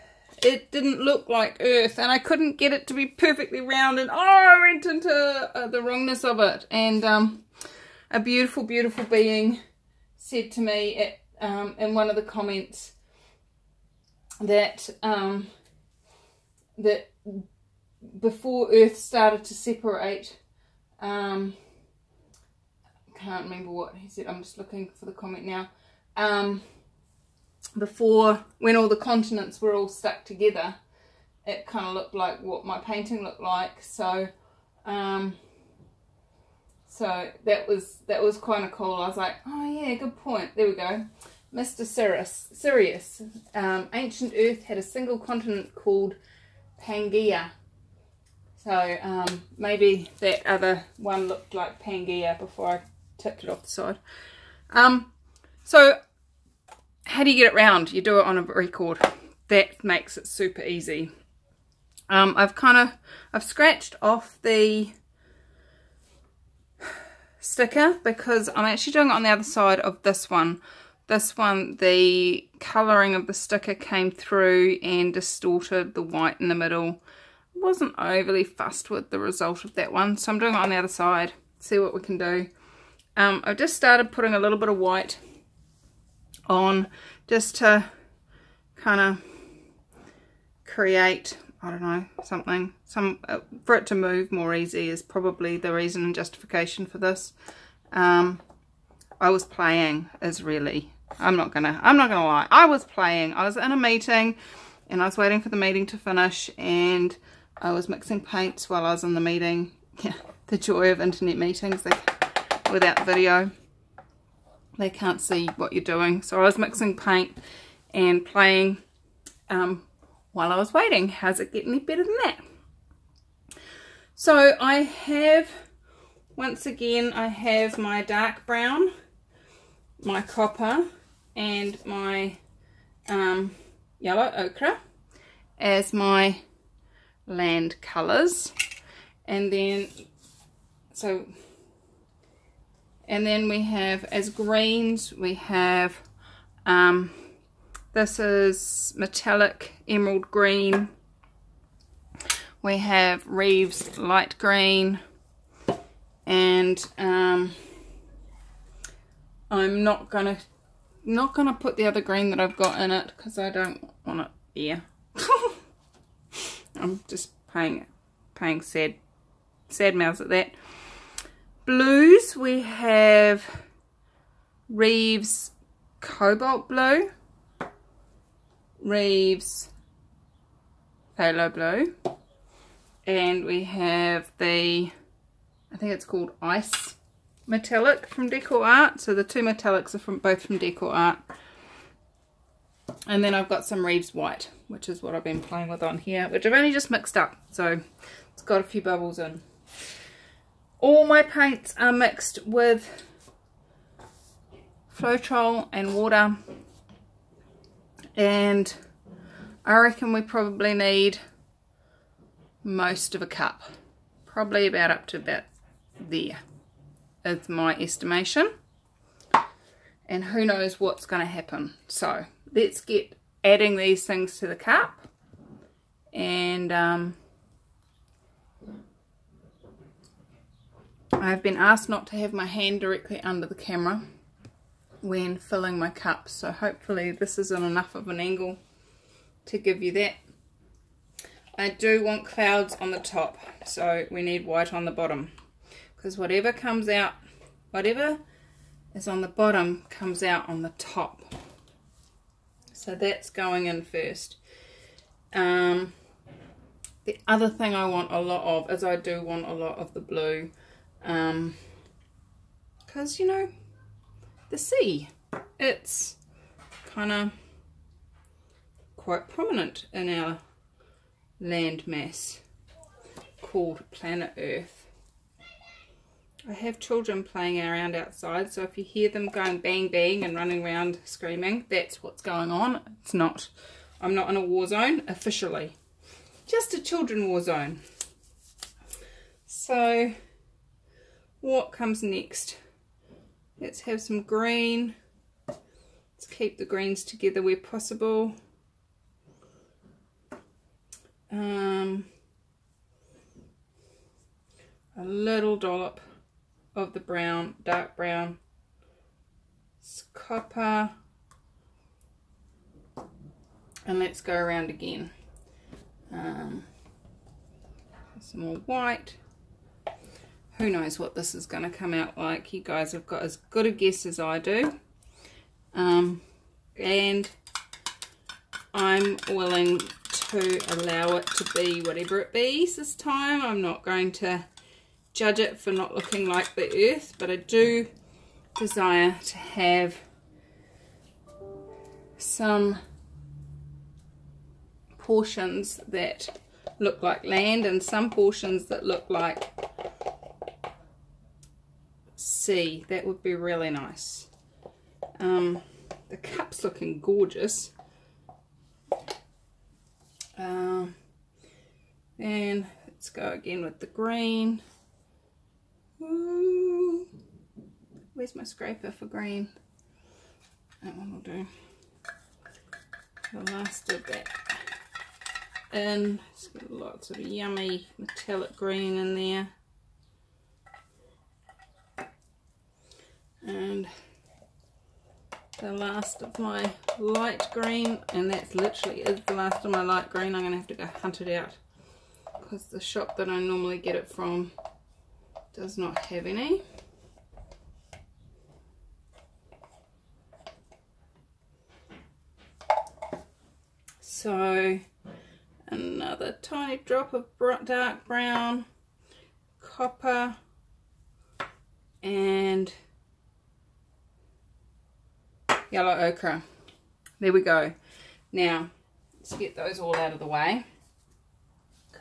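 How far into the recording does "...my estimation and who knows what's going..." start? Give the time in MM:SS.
03:37.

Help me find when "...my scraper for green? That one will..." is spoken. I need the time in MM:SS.
06:08.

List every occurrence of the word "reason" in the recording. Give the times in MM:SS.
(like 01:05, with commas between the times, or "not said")
01:35.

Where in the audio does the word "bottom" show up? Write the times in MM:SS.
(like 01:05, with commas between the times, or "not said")
04:04, 04:09.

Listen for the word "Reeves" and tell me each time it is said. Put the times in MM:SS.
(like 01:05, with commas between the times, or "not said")
02:33, 02:54, 02:58, 03:13.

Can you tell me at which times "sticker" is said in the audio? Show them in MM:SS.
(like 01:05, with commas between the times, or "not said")
01:07, 01:13.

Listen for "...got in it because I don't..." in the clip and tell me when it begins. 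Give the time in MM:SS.
02:42.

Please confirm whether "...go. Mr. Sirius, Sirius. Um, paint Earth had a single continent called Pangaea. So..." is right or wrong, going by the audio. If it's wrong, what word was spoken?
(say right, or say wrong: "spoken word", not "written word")
wrong: "ancient", not "paint".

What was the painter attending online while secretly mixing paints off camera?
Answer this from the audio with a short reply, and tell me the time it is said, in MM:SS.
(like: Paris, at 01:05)
A meeting, at 01:43.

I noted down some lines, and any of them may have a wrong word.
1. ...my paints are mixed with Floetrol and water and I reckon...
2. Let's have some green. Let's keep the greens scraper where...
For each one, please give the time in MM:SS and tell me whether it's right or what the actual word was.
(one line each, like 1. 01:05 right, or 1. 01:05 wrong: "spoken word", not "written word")
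1. 03:21 right
2. 04:53 wrong: "together", not "scraper".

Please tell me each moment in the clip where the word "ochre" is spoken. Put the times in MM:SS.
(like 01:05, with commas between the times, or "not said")
02:14, 06:55.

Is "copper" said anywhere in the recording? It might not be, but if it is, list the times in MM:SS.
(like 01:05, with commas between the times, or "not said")
02:10, 05:10, 06:49.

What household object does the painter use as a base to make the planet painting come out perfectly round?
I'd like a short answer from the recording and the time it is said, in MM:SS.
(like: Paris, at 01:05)
A record, at 00:58.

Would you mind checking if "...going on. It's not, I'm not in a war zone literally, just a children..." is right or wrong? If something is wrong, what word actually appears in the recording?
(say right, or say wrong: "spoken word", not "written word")
wrong: "officially", not "literally".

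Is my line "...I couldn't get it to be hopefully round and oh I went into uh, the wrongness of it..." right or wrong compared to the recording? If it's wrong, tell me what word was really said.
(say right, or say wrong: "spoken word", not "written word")
wrong: "perfectly", not "hopefully".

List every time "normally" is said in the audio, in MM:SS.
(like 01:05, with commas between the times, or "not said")
06:33.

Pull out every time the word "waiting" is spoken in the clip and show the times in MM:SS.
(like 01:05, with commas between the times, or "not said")
01:45, 02:00.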